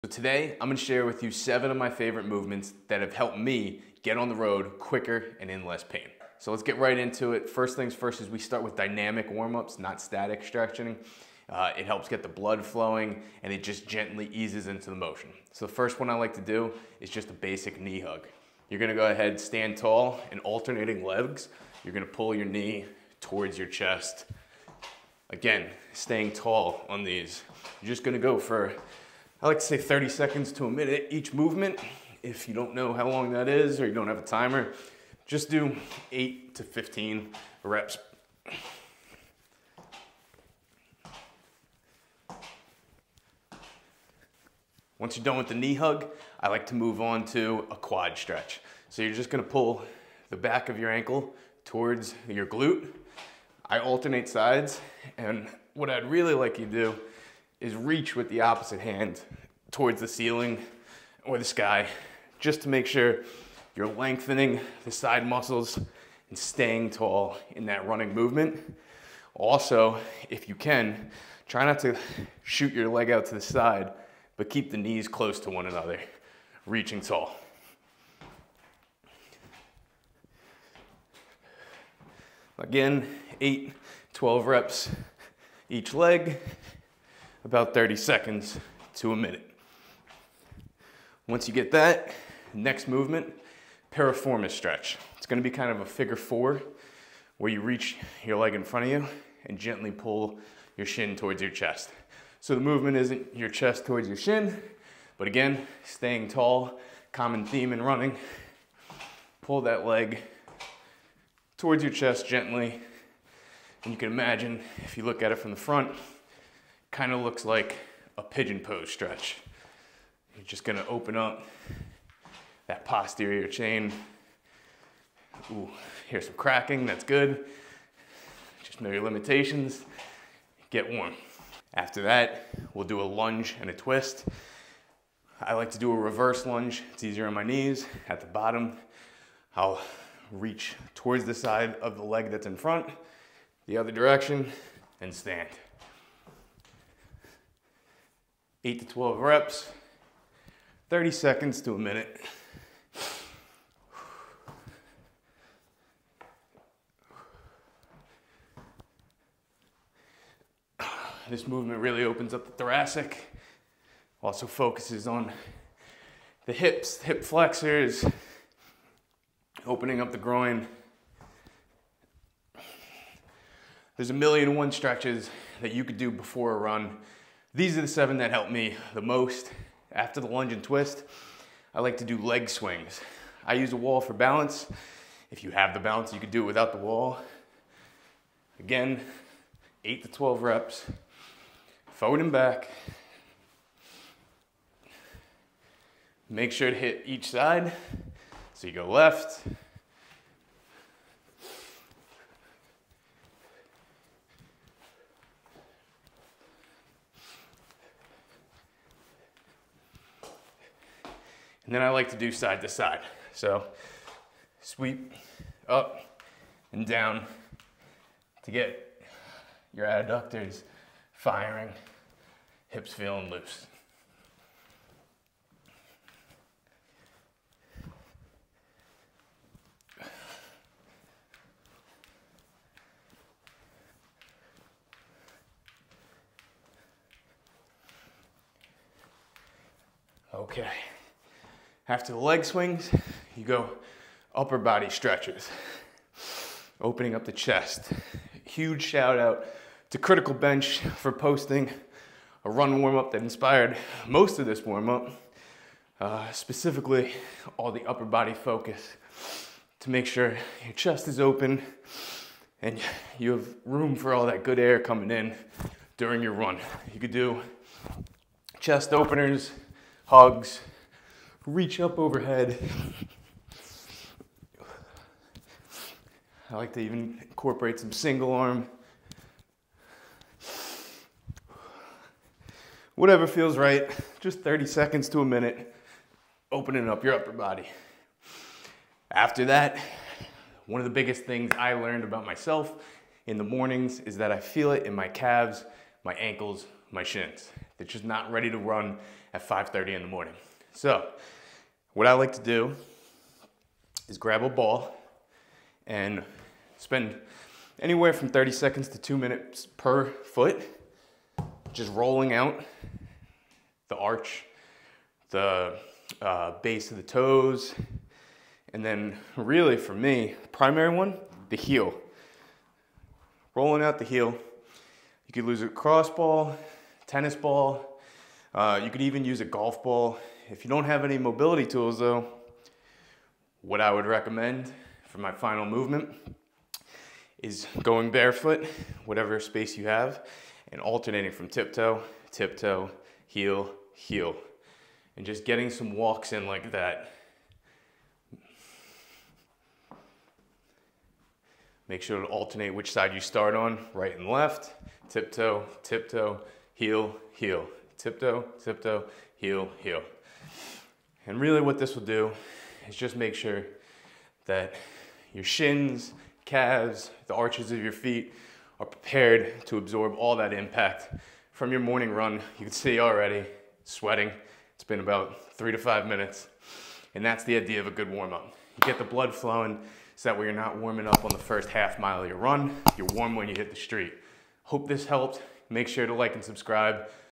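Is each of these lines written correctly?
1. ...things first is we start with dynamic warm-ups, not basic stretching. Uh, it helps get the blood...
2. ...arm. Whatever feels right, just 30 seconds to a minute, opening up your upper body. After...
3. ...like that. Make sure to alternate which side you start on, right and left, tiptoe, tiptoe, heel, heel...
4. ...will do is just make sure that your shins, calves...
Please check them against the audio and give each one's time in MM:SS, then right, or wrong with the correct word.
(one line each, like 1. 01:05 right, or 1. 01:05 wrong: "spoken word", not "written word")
1. 00:07 wrong: "static", not "basic"
2. 04:38 right
3. 05:46 right
4. 06:01 right.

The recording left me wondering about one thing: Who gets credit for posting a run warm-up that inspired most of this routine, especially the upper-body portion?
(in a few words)
Critical Bench.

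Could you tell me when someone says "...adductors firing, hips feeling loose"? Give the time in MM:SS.
03:39.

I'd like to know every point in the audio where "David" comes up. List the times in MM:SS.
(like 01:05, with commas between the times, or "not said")
not said.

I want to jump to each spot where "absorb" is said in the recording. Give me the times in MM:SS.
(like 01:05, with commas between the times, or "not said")
06:09.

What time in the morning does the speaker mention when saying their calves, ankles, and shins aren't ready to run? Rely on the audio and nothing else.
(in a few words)
5:30.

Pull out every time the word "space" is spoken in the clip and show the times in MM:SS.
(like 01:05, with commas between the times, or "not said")
05:39.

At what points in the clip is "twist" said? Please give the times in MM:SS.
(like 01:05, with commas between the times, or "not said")
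02:13, 03:00.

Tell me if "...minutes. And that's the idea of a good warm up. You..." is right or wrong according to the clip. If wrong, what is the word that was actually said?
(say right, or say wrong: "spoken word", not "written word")
right.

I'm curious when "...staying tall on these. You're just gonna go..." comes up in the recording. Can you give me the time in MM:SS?
00:25.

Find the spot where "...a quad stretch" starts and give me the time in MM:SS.
00:47.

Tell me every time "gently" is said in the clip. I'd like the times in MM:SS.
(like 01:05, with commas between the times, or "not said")
00:13, 01:39, 01:52.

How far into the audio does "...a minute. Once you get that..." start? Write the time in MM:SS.
01:29.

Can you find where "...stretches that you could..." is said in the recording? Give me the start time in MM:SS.
02:54.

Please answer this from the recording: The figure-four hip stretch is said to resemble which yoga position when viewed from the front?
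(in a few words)
pigeon pose.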